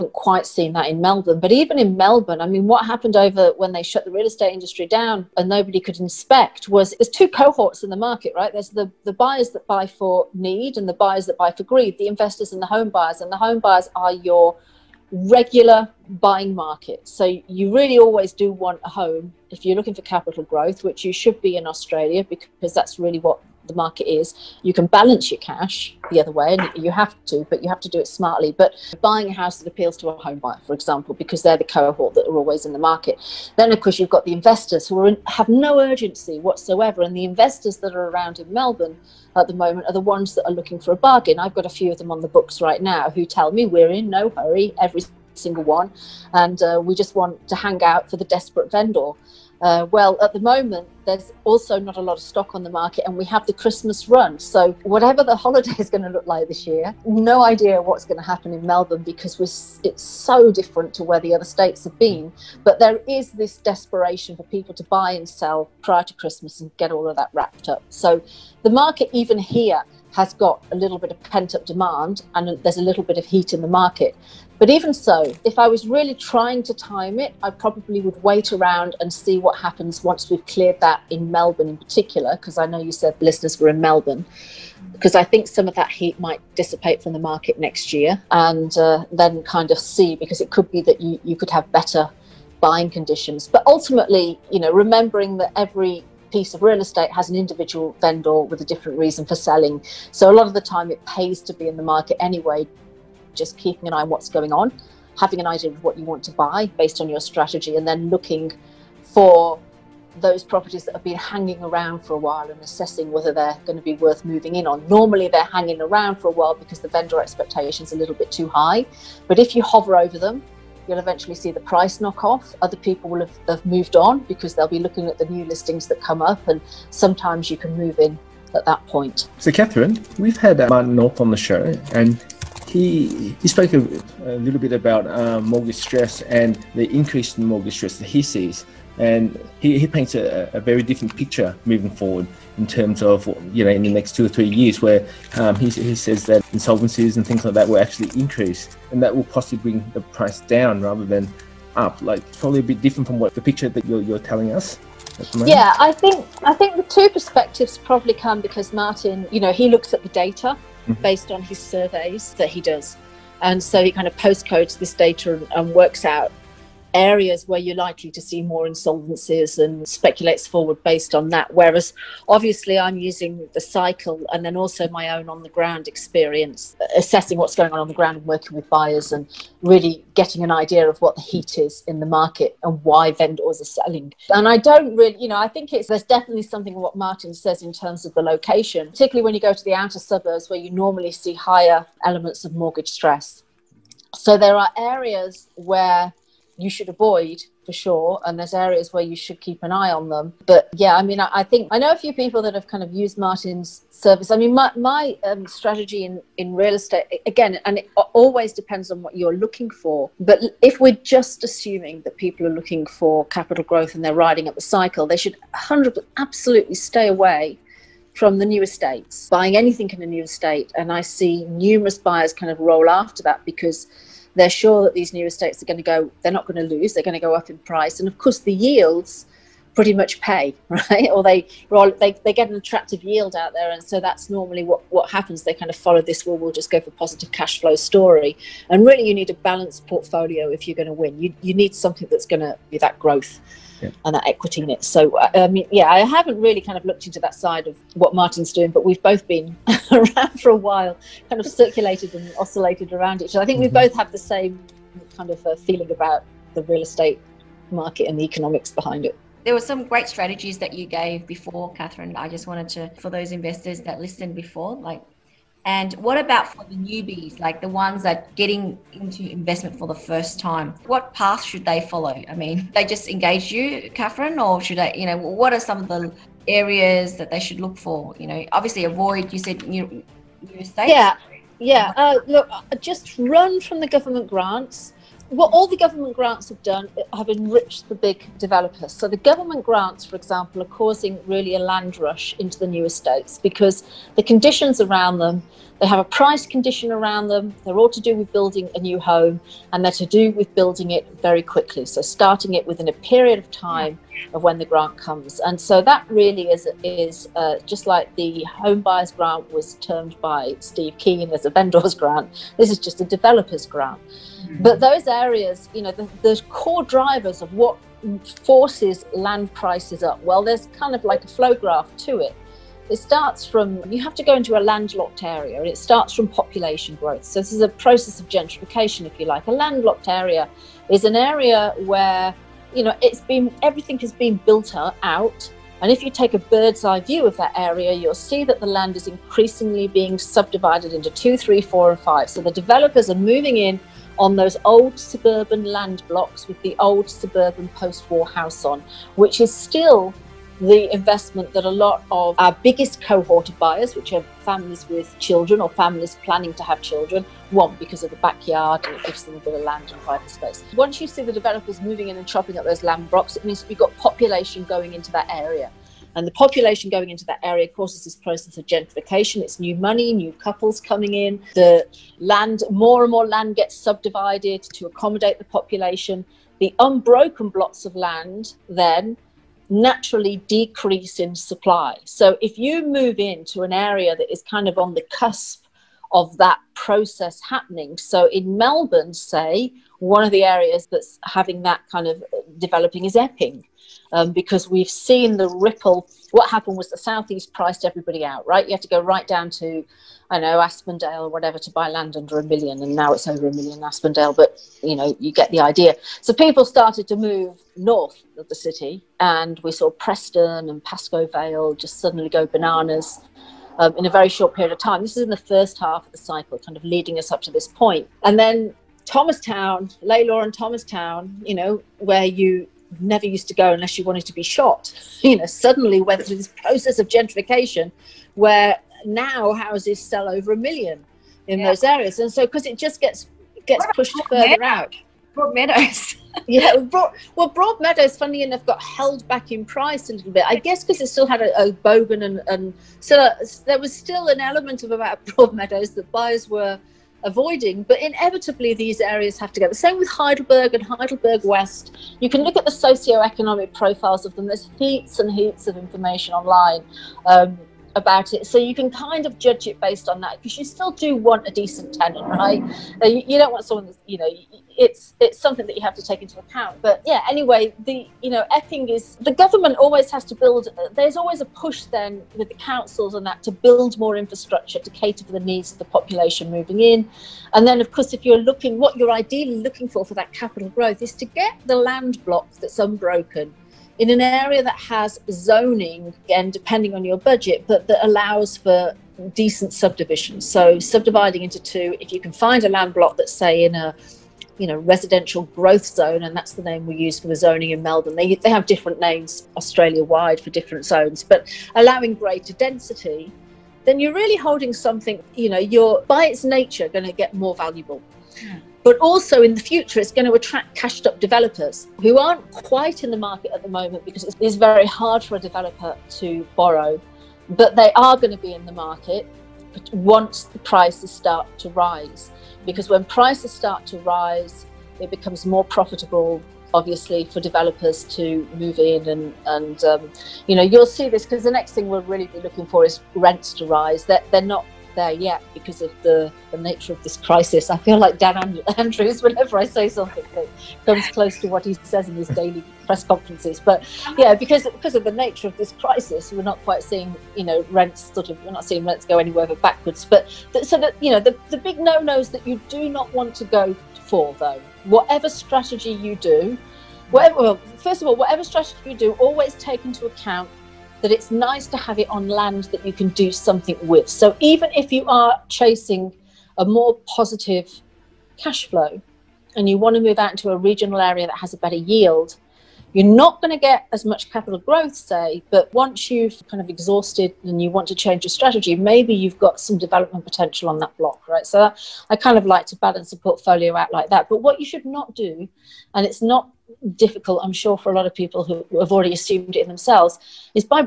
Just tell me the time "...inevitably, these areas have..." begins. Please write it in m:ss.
7:28.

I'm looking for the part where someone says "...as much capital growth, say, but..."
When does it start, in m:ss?
9:33.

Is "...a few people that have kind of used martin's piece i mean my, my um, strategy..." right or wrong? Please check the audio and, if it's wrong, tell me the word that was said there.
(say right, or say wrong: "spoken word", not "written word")
wrong: "service", not "piece".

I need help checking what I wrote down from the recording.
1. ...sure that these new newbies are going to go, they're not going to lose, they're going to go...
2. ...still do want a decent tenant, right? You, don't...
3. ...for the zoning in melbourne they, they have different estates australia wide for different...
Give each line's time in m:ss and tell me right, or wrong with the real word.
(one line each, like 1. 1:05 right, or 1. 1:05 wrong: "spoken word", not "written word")
1. 3:44 wrong: "estates", not "newbies"
2. 7:40 right
3. 8:17 wrong: "names", not "estates".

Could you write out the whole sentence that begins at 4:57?
They're all to do with building a new home and they're to do with building it very quickly.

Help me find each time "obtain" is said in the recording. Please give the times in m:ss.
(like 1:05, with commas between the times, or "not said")
not said.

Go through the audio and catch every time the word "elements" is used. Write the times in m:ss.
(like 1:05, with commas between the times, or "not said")
3:12, 7:24.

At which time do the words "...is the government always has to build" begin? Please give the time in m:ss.
7:48.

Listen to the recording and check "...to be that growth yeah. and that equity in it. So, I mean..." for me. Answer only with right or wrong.
right.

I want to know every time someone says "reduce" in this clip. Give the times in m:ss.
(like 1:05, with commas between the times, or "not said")
not said.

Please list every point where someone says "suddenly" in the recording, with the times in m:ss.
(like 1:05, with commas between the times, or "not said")
6:51, 7:05.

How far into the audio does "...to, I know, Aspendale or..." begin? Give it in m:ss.
6:39.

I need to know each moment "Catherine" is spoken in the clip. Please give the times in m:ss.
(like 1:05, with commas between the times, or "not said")
2:09, 4:21, 4:33.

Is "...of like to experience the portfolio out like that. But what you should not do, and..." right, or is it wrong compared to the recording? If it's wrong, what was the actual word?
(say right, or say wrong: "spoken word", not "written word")
wrong: "balance", not "experience".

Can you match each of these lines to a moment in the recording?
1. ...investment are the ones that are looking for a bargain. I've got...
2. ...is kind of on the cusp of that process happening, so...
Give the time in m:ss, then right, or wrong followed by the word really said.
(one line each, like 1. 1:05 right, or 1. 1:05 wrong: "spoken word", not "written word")
1. 0:39 wrong: "moment", not "investment"
2. 6:24 right.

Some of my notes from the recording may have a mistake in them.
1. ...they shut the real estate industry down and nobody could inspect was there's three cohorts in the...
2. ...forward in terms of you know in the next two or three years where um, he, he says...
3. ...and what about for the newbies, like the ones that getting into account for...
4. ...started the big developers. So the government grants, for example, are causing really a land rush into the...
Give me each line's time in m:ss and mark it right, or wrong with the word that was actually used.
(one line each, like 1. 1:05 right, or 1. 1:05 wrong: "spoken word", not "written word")
1. 0:03 wrong: "two", not "three"
2. 2:21 right
3. 4:25 wrong: "investment", not "account"
4. 4:47 wrong: "enriched", not "started".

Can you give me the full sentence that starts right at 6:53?
Um, in a very short period of time.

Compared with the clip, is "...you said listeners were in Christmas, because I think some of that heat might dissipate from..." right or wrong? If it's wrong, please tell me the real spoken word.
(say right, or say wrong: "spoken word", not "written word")
wrong: "Melbourne", not "Christmas".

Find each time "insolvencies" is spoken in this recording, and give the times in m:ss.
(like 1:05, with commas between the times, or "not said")
2:26, 2:48.